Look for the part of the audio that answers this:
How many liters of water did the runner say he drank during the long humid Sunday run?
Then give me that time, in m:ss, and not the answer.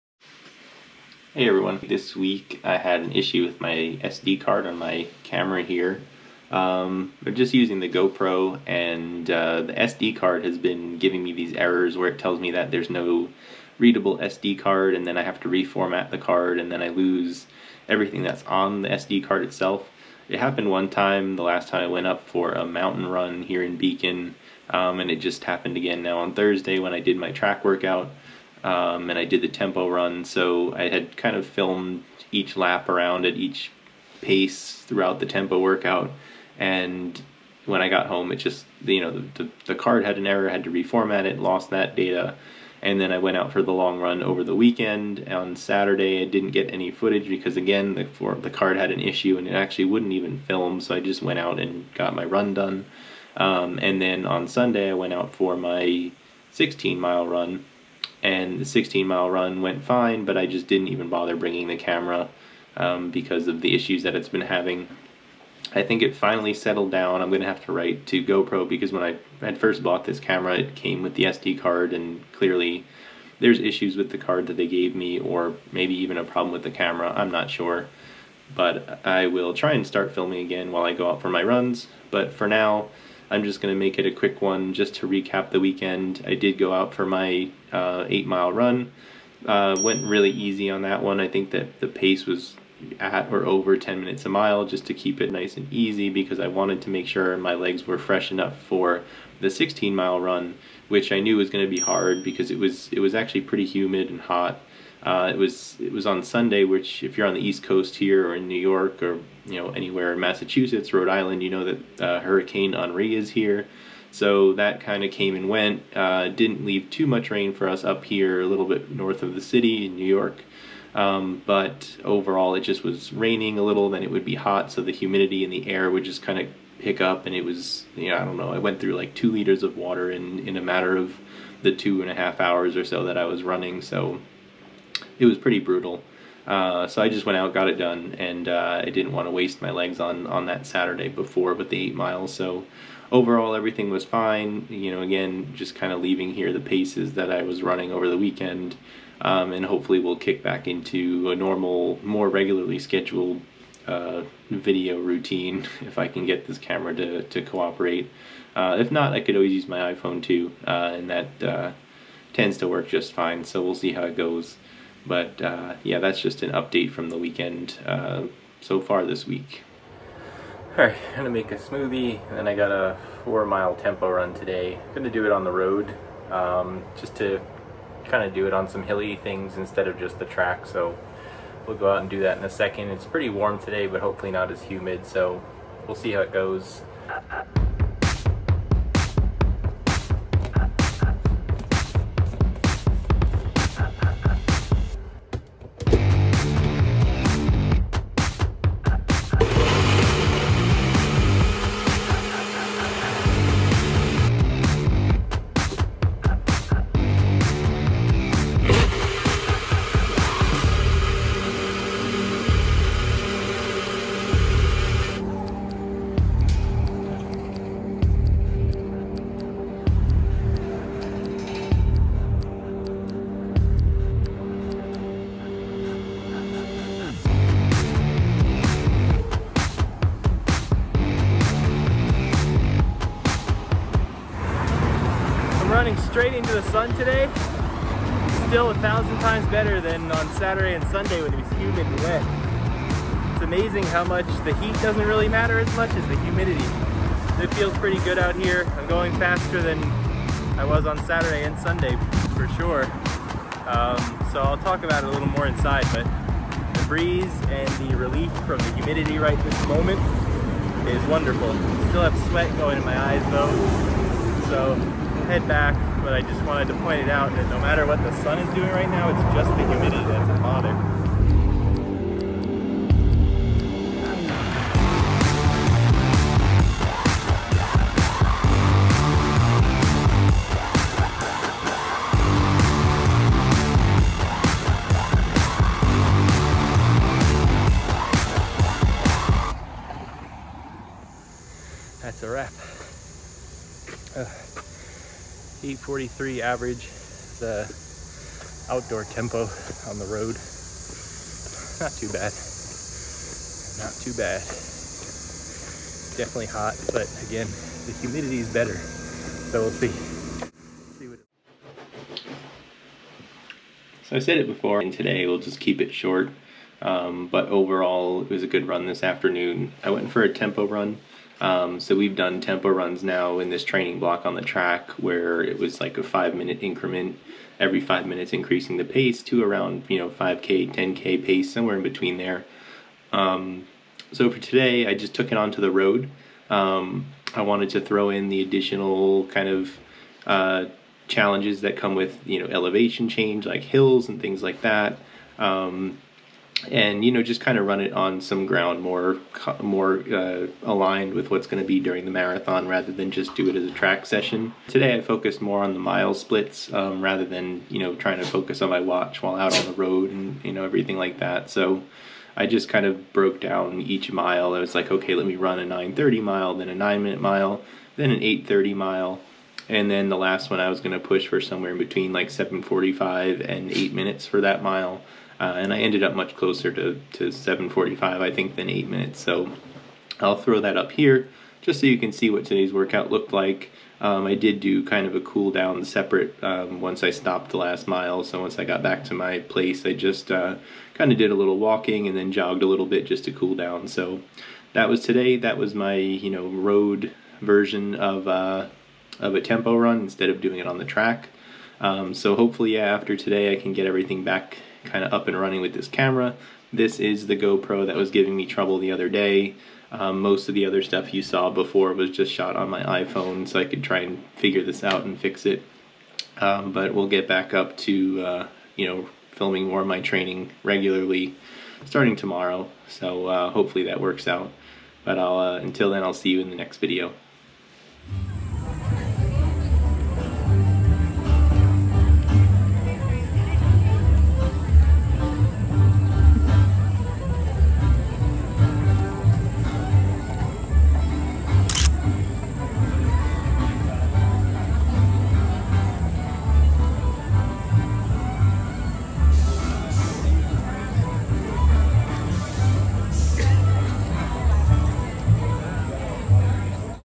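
2:09.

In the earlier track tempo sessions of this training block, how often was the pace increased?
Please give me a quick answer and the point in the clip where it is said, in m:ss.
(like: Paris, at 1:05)
every 5 minutes, at 5:27.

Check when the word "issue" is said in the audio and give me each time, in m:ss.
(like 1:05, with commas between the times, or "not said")
0:03, 0:49, 1:03, 1:13.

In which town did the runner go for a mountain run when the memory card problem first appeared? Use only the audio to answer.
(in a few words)
Beacon.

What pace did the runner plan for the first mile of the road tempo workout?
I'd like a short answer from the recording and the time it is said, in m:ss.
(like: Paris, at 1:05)
9:30, at 6:05.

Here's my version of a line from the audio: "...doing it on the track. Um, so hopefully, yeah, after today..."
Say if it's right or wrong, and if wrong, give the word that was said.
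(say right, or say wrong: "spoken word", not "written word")
right.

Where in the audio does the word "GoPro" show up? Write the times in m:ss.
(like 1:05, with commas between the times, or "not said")
0:07, 1:08, 6:47.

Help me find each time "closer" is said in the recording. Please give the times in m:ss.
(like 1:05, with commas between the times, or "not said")
6:16.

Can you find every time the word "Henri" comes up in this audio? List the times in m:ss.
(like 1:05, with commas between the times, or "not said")
1:52.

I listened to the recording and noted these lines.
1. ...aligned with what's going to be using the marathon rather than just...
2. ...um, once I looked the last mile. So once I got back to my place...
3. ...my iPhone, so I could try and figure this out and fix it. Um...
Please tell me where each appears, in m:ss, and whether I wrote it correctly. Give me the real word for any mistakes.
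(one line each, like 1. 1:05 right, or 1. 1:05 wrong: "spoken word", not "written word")
1. 5:50 wrong: "during", not "using"
2. 6:26 wrong: "stopped", not "looked"
3. 6:52 right.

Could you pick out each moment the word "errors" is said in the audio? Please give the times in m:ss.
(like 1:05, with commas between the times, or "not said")
0:11, 0:40.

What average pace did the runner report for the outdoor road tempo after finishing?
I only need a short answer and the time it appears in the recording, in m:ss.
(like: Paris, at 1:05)
8:43, at 4:55.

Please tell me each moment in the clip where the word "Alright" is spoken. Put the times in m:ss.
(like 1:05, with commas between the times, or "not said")
2:50.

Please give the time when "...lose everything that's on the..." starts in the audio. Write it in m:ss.
0:16.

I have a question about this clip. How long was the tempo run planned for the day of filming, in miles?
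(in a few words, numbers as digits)
4 miles.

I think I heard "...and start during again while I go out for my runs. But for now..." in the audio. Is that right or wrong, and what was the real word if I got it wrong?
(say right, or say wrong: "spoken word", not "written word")
wrong: "filming", not "during".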